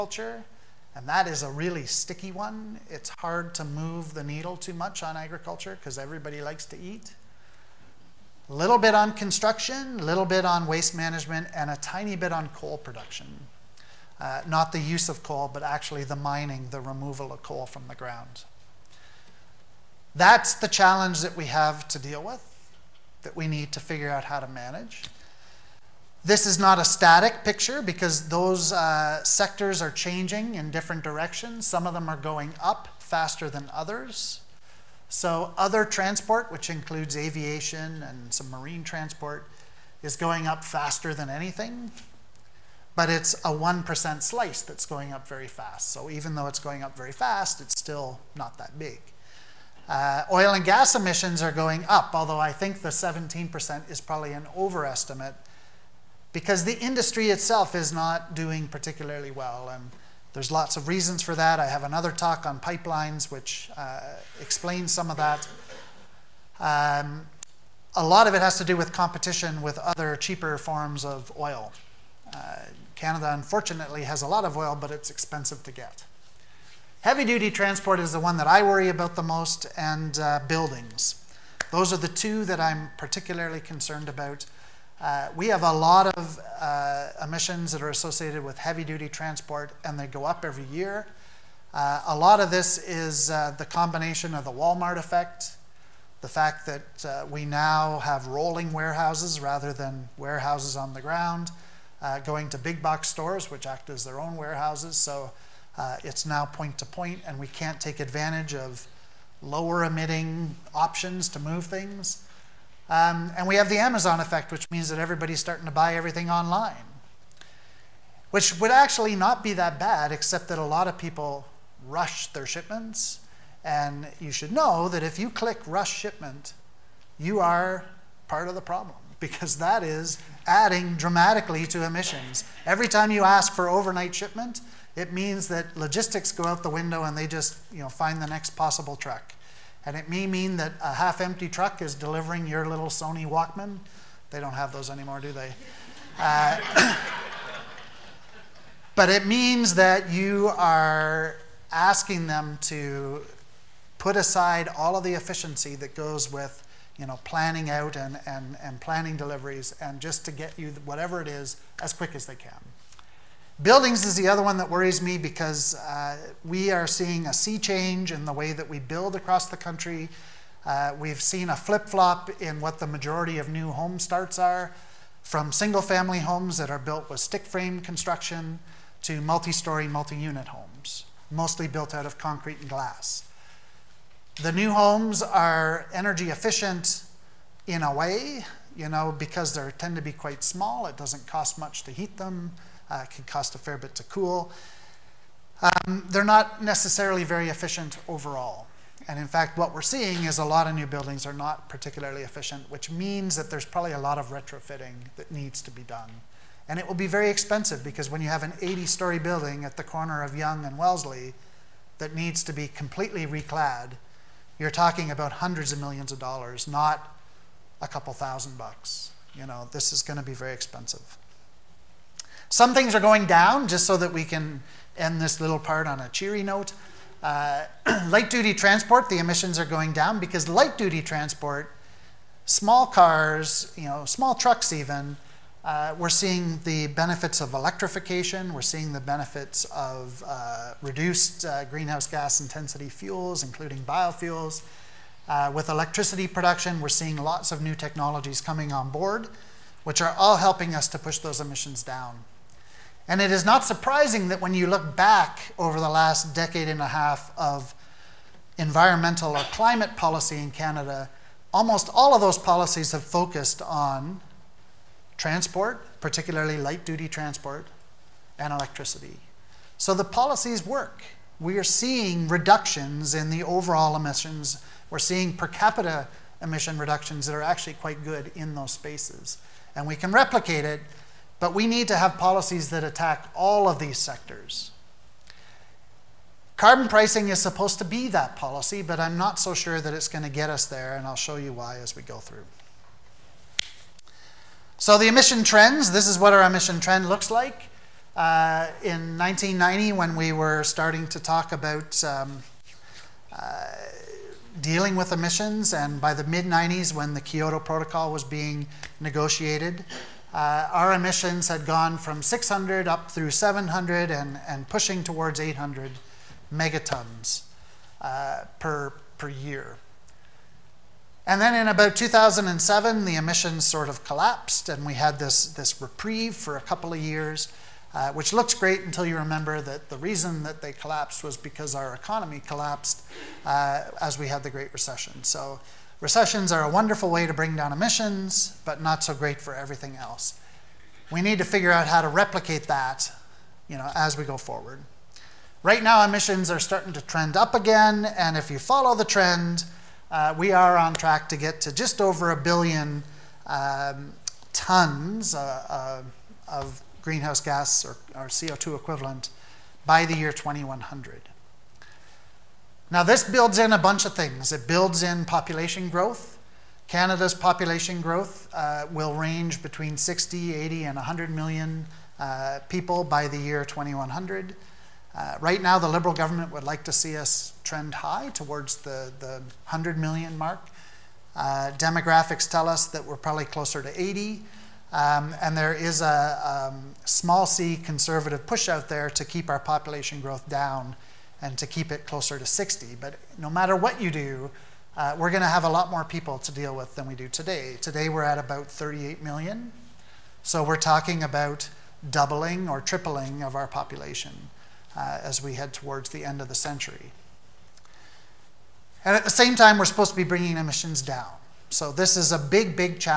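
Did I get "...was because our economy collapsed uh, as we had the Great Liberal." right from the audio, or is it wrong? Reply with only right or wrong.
wrong.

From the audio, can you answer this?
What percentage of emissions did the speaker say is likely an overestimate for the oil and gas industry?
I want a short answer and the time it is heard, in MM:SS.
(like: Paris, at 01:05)
17%, at 00:52.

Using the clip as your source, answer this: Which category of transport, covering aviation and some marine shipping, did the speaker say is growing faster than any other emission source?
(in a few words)
Other transport.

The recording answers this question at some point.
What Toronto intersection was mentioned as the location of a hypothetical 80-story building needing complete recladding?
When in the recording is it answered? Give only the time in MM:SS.
03:30.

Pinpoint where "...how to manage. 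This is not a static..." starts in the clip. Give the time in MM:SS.
00:24.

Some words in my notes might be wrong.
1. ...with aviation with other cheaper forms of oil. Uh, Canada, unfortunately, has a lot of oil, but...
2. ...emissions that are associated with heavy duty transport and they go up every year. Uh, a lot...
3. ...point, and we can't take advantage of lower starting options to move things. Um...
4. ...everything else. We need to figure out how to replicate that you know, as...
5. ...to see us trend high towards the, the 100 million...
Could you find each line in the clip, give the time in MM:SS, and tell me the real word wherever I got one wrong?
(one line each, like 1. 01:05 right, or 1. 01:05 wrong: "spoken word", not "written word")
1. 01:08 wrong: "competition", not "aviation"
2. 01:27 right
3. 01:46 wrong: "emitting", not "starting"
4. 05:39 right
5. 06:16 right.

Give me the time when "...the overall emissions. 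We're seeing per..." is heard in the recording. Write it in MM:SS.
04:33.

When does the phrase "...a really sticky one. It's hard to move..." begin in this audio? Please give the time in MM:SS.
00:01.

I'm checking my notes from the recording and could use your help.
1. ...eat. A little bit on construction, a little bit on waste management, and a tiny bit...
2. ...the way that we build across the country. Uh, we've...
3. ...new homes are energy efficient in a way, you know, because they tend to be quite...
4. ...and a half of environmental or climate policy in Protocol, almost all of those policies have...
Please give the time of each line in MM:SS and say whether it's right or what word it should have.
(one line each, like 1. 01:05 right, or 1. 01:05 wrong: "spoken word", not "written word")
1. 00:06 right
2. 02:48 right
3. 03:04 right
4. 04:16 wrong: "Canada", not "Protocol".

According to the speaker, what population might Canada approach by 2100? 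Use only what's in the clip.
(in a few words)
80 million.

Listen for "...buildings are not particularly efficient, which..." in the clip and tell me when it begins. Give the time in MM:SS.
03:20.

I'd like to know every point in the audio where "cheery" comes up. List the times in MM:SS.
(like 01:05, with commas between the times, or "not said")
03:46.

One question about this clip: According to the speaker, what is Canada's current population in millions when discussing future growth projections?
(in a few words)
38 million.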